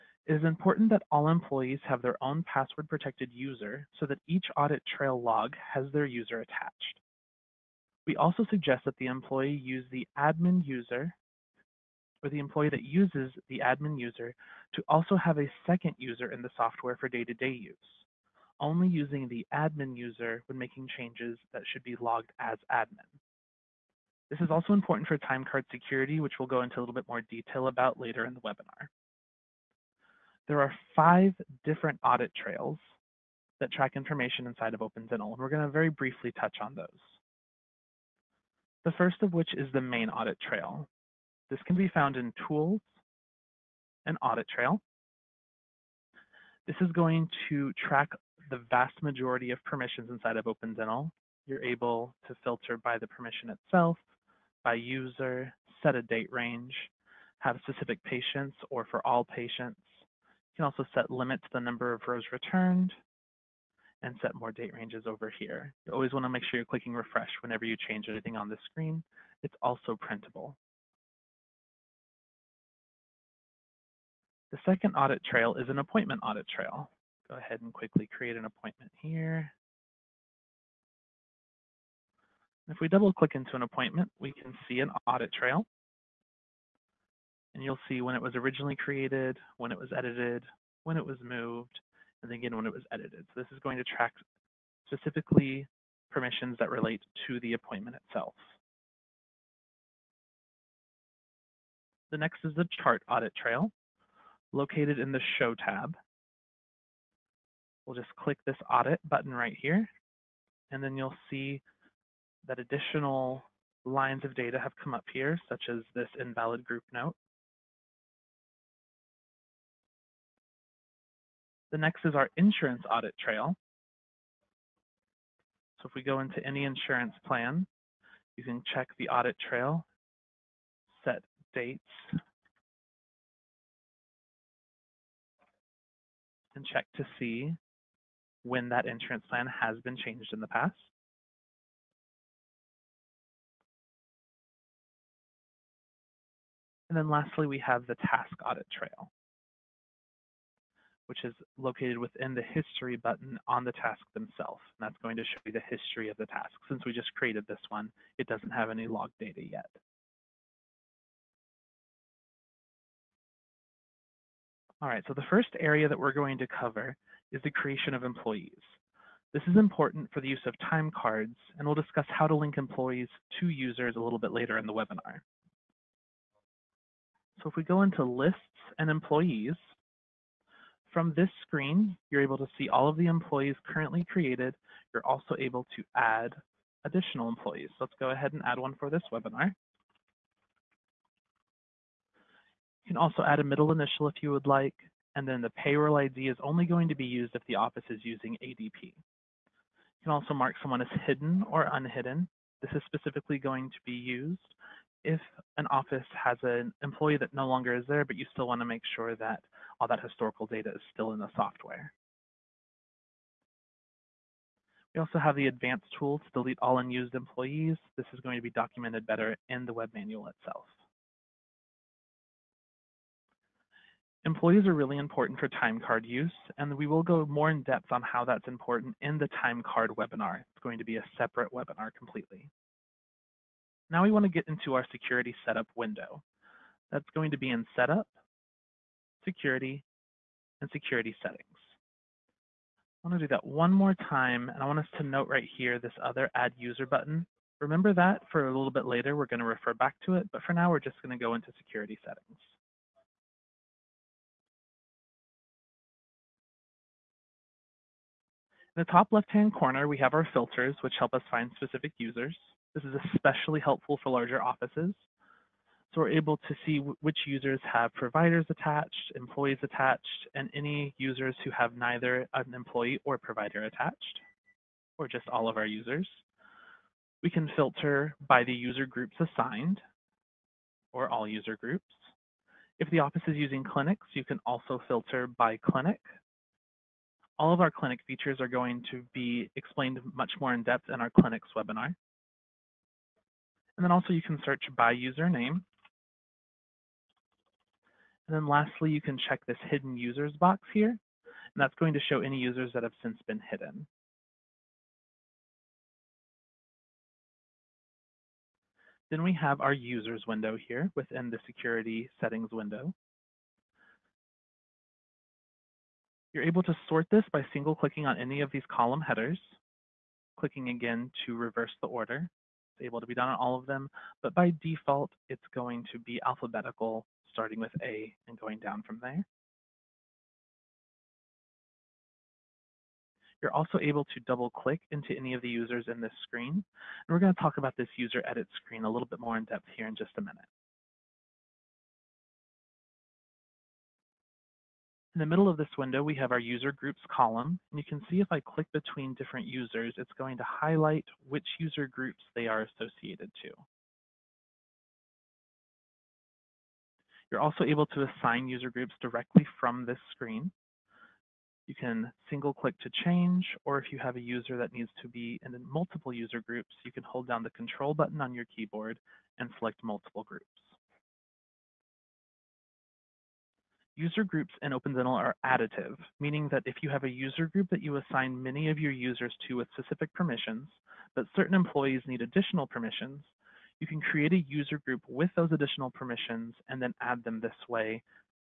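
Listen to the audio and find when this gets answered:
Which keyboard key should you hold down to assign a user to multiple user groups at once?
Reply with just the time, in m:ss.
6:07.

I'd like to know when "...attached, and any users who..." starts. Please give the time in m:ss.
4:29.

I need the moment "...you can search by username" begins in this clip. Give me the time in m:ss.
4:54.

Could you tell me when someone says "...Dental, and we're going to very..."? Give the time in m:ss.
0:35.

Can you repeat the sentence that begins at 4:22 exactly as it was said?
This is especially helpful for larger offices.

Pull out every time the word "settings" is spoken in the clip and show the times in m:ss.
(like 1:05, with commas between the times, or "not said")
4:01, 4:12, 5:12.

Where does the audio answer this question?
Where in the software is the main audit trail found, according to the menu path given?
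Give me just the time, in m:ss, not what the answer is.
0:42.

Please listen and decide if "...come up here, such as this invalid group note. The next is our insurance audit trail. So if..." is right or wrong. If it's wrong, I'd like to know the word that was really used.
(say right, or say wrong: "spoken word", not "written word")
right.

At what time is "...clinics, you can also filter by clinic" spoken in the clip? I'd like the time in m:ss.
4:43.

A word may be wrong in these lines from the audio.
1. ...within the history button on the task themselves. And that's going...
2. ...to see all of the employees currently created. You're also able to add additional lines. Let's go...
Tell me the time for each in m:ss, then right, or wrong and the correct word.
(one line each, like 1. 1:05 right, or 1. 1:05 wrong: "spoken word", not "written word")
1. 2:31 right
2. 3:02 wrong: "employees", not "lines".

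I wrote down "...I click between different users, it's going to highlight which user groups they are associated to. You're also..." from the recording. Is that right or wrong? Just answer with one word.
right.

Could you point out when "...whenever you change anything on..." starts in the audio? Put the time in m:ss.
1:07.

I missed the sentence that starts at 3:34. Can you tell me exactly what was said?
We also have the advanced tool to delete all unused employees.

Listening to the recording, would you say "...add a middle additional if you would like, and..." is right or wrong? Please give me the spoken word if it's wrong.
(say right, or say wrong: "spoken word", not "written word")
wrong: "initial", not "additional".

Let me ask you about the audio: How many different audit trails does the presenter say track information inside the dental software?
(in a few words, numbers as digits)
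5.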